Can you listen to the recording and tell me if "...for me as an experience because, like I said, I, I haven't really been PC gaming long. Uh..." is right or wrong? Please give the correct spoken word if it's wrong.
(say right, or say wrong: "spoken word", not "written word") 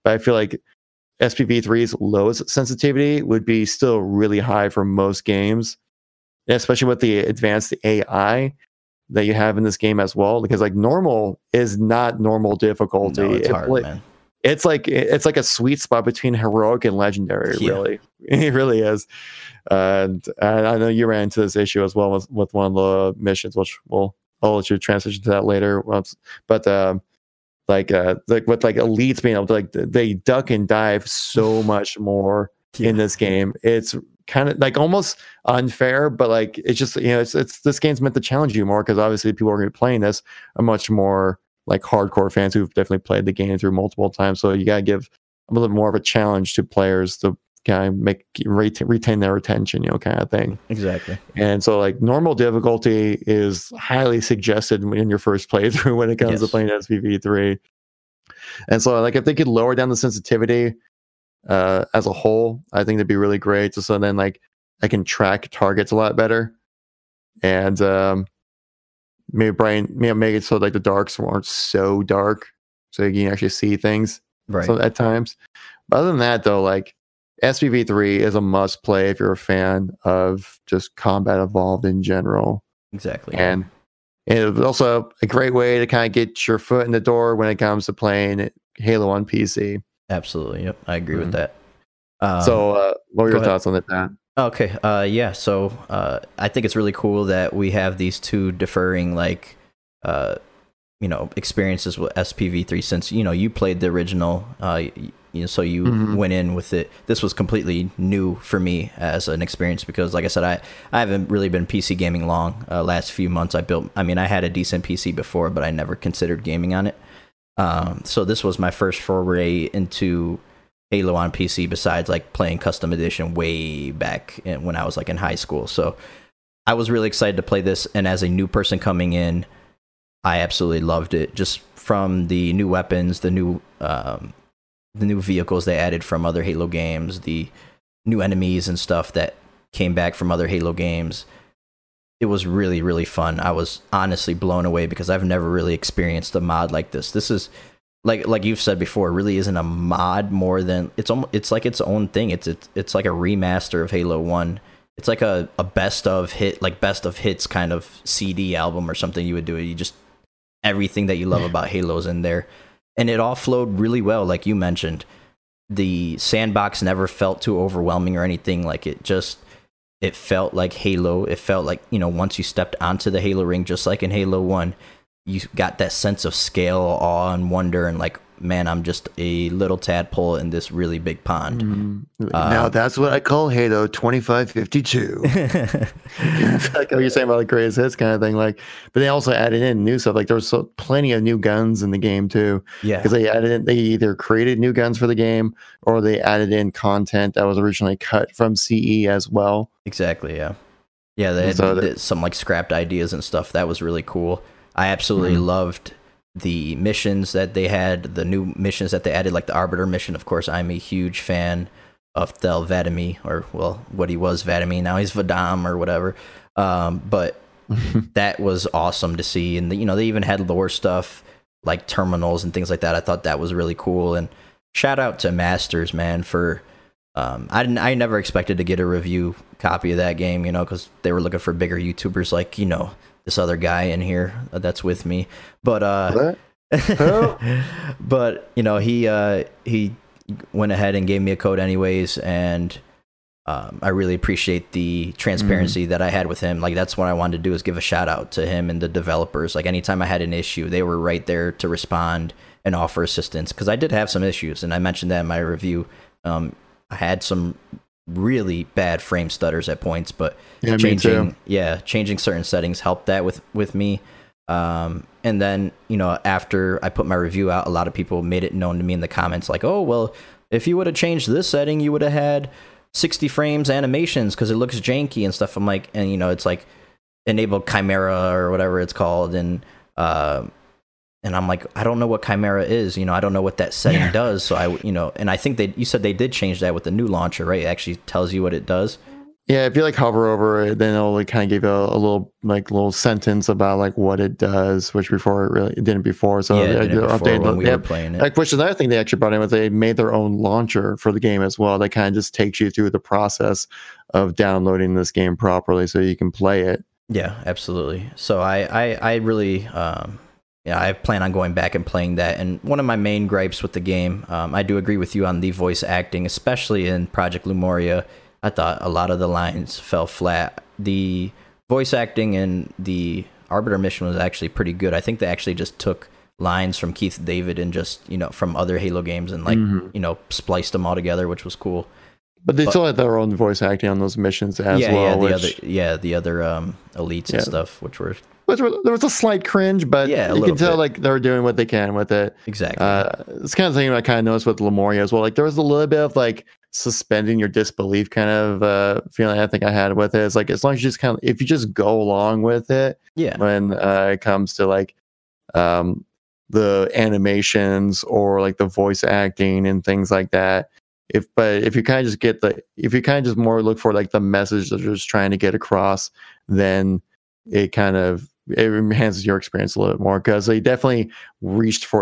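right.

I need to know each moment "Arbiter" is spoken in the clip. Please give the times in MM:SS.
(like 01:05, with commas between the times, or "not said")
03:29, 05:23.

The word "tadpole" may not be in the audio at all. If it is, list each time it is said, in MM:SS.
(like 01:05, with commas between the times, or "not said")
02:59.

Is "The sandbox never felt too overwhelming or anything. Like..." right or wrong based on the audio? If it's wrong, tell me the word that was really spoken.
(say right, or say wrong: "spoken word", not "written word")
right.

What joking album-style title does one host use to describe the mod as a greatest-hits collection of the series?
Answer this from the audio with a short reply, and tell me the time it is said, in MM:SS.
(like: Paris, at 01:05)
Halo 2552, at 03:03.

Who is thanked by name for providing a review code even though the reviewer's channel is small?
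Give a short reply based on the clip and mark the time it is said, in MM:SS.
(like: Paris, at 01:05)
Masters, at 03:45.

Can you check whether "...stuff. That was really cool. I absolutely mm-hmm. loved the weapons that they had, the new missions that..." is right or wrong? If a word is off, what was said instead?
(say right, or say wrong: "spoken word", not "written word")
wrong: "missions", not "weapons".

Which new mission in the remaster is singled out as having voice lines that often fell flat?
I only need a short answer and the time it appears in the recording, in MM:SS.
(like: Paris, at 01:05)
Project Lemuria, at 05:17.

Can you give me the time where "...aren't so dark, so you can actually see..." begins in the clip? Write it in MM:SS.
01:11.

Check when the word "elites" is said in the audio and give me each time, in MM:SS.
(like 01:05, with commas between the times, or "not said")
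00:28, 05:36.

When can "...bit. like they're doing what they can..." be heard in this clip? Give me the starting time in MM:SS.
05:40.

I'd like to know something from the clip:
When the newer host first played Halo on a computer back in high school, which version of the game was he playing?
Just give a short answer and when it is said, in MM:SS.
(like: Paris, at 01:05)
Custom Edition, at 02:02.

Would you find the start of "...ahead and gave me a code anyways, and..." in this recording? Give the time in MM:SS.
04:00.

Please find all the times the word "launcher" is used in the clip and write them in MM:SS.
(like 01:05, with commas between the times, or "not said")
04:47, 05:00.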